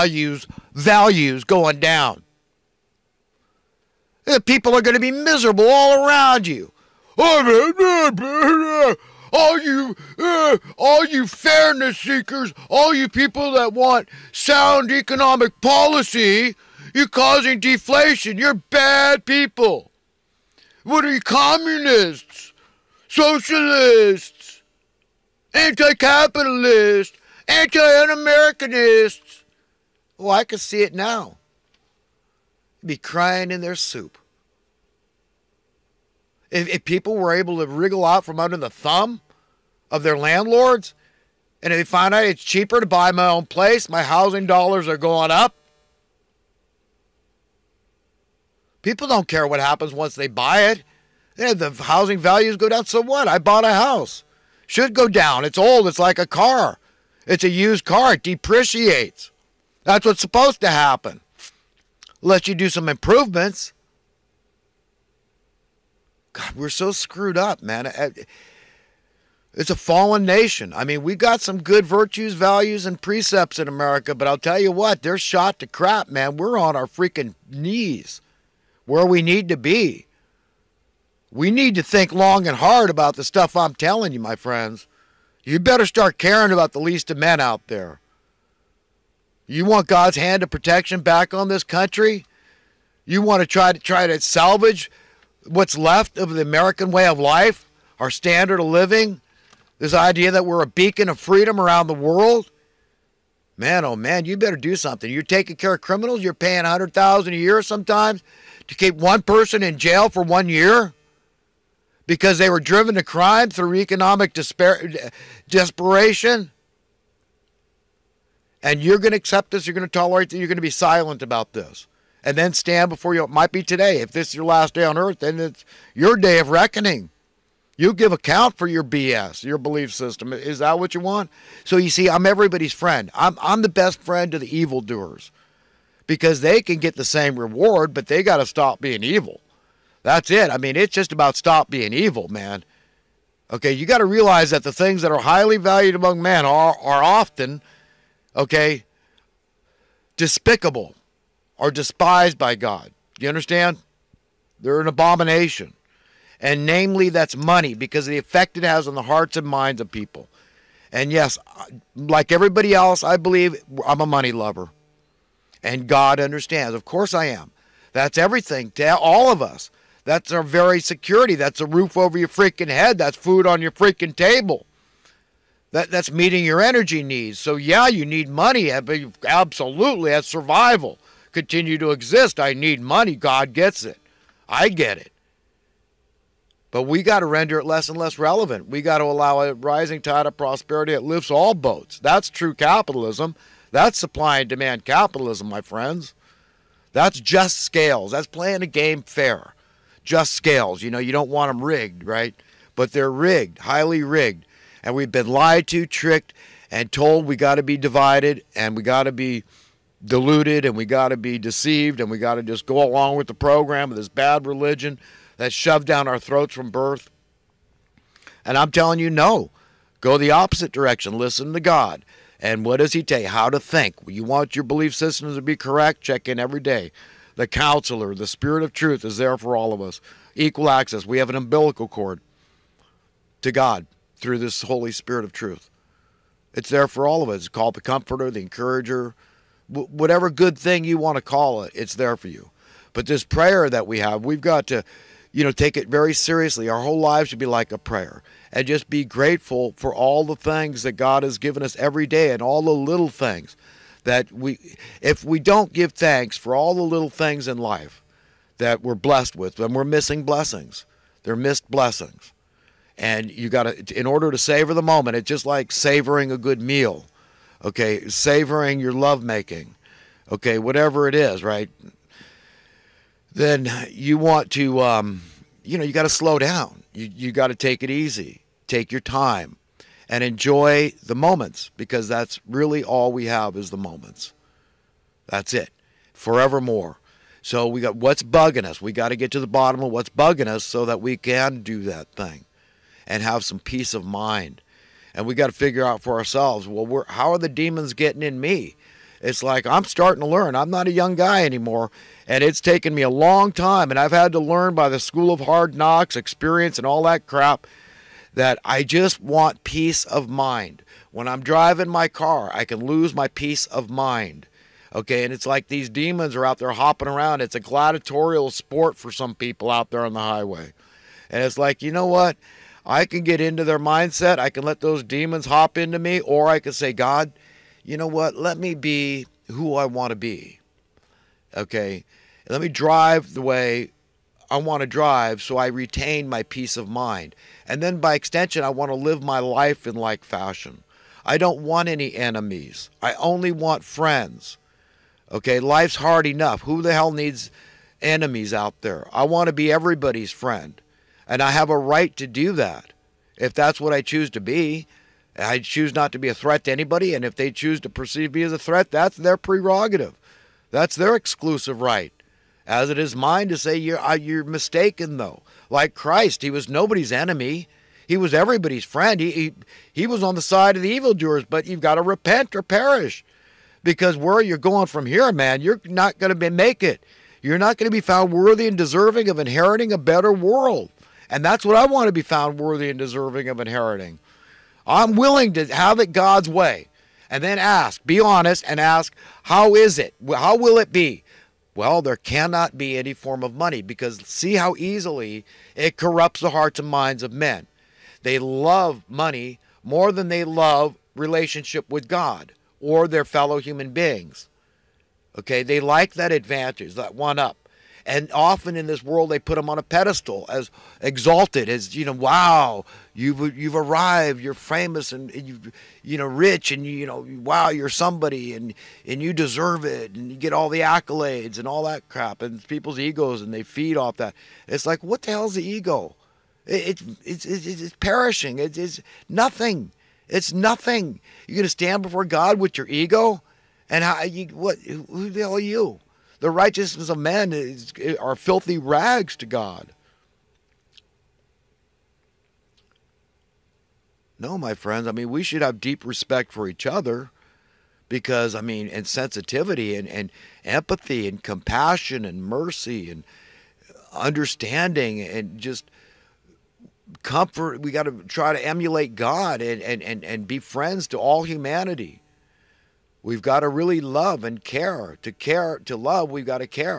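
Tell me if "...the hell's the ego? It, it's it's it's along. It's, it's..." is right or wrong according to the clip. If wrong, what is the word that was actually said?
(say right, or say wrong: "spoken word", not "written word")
wrong: "perishing", not "along".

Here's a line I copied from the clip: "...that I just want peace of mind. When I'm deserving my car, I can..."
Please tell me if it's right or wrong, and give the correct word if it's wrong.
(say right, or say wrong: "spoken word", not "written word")
wrong: "driving", not "deserving".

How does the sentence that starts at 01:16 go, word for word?
We're on our freaking knees where we need to be.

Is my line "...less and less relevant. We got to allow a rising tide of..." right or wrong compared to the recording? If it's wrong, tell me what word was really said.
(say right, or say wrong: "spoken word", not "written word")
right.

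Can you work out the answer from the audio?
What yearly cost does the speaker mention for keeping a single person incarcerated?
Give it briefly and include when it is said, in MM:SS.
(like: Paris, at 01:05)
100,000, at 01:46.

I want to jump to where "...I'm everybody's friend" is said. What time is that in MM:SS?
02:12.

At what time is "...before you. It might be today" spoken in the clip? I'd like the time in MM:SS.
02:02.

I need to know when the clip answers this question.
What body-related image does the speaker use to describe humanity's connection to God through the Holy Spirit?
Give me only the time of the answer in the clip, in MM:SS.
03:51.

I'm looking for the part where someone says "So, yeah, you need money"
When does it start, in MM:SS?
02:57.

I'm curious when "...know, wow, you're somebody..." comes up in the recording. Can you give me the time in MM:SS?
06:57.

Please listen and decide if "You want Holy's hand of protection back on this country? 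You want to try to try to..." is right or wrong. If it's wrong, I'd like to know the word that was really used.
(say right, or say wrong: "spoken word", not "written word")
wrong: "God", not "Holy".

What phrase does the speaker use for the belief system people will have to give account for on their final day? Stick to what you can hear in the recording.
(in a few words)
your BS.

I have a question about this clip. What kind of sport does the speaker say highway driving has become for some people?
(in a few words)
gladiatorial.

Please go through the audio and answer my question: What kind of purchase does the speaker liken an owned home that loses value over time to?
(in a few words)
a used car.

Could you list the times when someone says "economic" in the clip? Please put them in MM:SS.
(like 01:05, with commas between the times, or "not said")
00:14, 01:53.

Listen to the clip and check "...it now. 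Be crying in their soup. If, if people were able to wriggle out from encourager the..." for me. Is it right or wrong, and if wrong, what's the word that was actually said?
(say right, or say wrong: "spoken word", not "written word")
wrong: "under", not "encourager".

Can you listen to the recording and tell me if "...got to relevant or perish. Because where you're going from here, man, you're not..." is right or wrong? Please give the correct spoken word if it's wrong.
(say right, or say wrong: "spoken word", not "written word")
wrong: "repent", not "relevant".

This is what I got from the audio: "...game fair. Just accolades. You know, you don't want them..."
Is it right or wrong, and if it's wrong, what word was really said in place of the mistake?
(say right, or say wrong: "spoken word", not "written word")
wrong: "scales", not "accolades".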